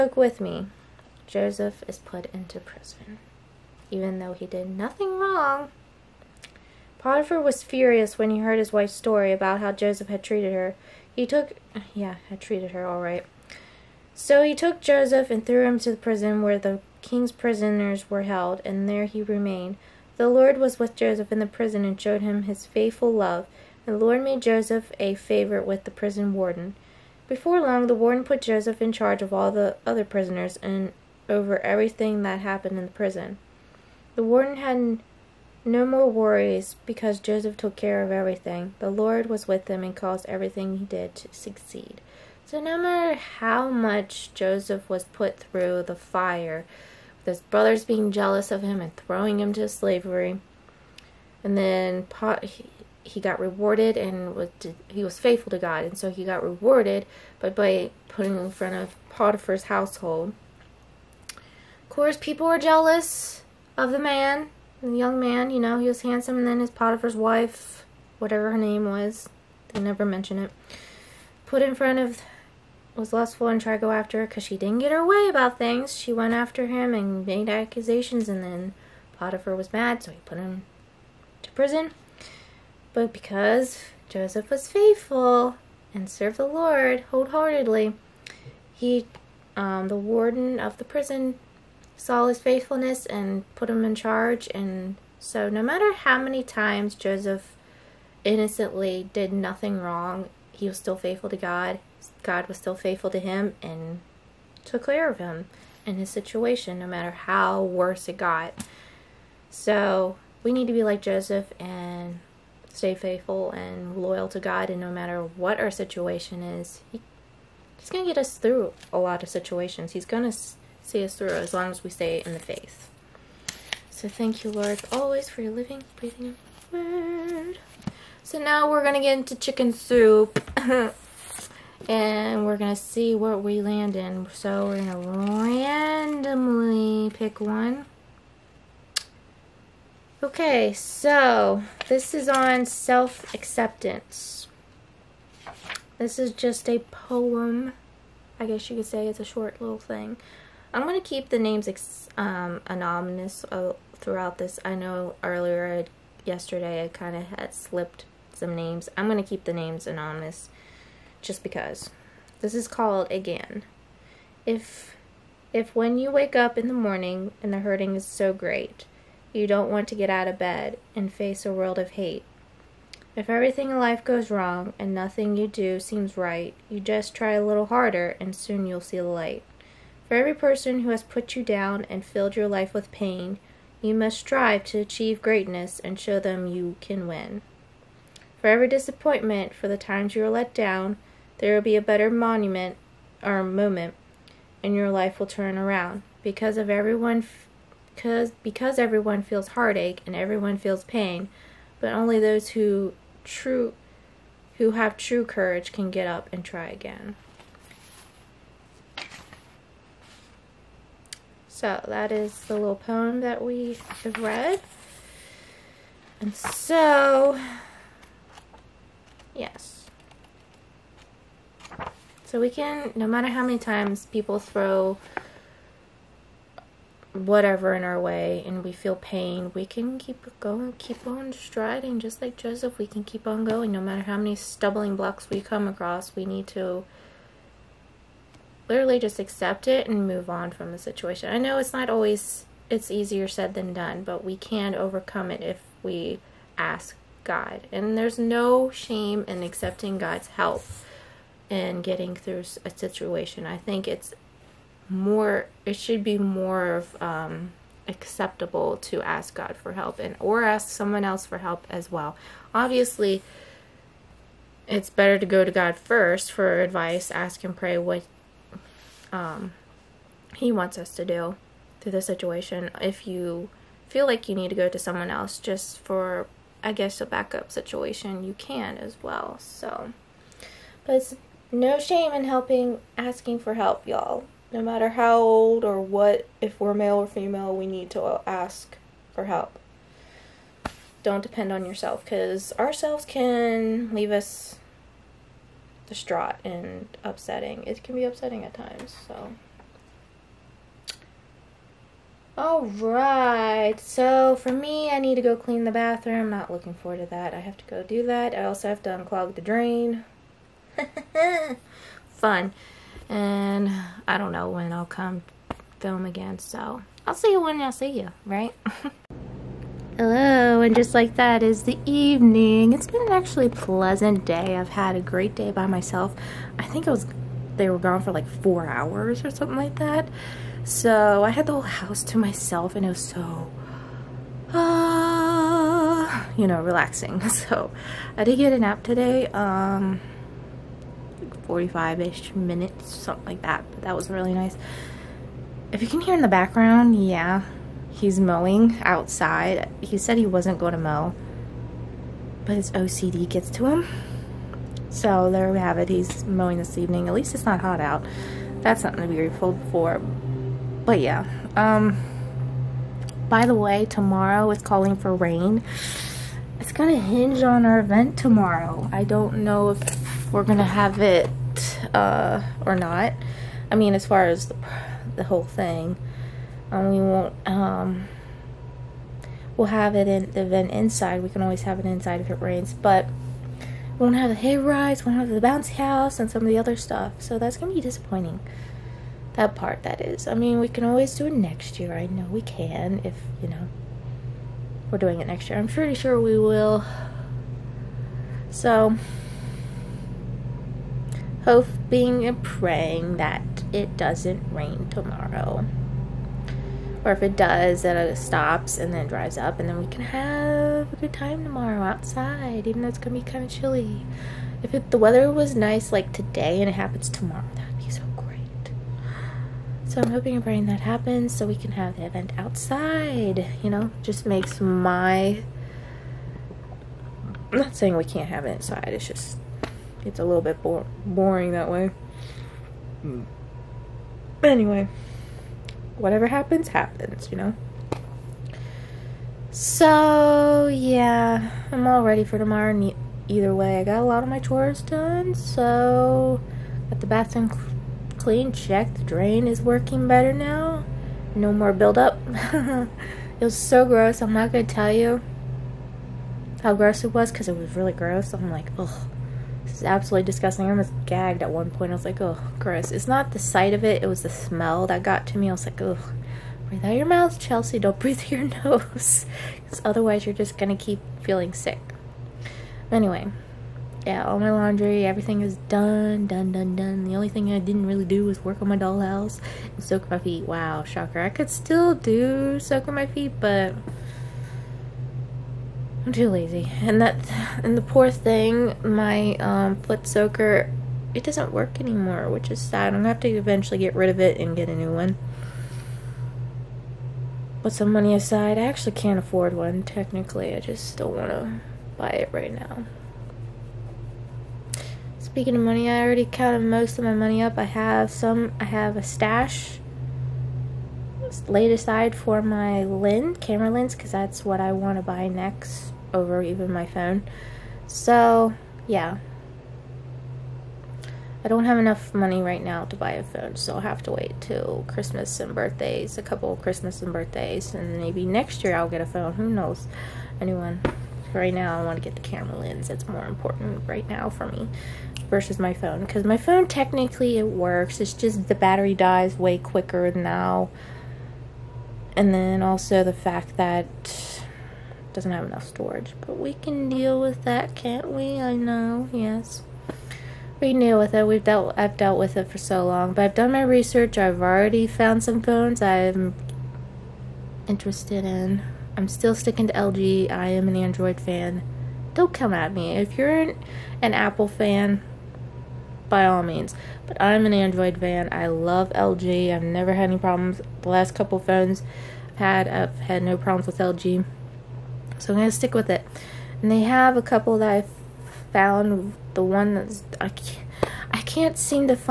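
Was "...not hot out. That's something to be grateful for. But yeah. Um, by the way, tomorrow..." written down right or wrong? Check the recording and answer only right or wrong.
right.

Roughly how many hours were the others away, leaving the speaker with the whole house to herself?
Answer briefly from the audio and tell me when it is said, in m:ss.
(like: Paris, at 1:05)
4 hours, at 5:28.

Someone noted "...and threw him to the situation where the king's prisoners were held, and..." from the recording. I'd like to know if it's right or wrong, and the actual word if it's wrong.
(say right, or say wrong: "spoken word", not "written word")
wrong: "prison", not "situation".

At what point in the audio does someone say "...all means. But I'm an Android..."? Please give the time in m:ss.
9:26.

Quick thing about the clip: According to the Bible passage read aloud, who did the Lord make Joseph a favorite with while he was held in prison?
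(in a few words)
the prison warden.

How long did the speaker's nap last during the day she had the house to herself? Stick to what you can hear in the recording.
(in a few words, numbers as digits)
45 minutes.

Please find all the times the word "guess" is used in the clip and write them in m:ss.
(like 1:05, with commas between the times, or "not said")
2:28, 4:36.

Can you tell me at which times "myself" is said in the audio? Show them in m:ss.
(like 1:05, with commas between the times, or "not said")
5:25, 5:32.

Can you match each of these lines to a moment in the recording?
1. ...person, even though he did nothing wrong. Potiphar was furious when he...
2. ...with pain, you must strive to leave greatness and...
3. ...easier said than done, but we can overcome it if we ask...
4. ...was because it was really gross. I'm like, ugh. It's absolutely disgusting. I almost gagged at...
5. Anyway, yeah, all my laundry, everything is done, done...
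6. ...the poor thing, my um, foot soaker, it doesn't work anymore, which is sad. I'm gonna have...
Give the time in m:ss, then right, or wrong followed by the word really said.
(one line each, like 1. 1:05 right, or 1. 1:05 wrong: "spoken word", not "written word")
1. 0:02 wrong: "prison", not "person"
2. 3:02 wrong: "achieve", not "leave"
3. 4:02 right
4. 7:37 right
5. 7:52 right
6. 8:07 right.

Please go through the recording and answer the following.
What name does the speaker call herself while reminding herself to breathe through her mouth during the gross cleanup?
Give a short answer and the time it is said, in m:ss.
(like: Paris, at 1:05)
Chelsea, at 7:47.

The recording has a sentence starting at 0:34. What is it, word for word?
The warden had no more worries because Joseph took care of everything.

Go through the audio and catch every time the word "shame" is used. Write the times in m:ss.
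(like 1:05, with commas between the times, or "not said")
4:08, 4:41.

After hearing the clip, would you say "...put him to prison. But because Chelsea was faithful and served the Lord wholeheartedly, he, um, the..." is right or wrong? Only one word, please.
wrong.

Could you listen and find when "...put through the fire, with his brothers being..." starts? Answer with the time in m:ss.
0:45.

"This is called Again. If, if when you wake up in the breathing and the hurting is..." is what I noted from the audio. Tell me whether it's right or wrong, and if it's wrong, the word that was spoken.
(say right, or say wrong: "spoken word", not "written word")
wrong: "morning", not "breathing".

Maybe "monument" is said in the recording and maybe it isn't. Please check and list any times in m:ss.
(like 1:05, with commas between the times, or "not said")
3:12.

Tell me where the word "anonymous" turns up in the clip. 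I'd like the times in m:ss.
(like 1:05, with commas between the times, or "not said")
2:32, 2:39.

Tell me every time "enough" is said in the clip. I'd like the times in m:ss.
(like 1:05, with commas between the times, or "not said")
8:41, 9:05.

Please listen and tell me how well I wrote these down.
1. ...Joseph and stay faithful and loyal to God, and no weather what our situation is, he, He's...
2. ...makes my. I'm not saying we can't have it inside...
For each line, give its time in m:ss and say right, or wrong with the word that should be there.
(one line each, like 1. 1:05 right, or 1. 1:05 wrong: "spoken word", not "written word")
1. 1:51 wrong: "matter", not "weather"
2. 7:04 right.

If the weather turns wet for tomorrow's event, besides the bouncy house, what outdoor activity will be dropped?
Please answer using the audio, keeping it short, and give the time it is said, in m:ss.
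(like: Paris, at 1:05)
hay rides, at 6:24.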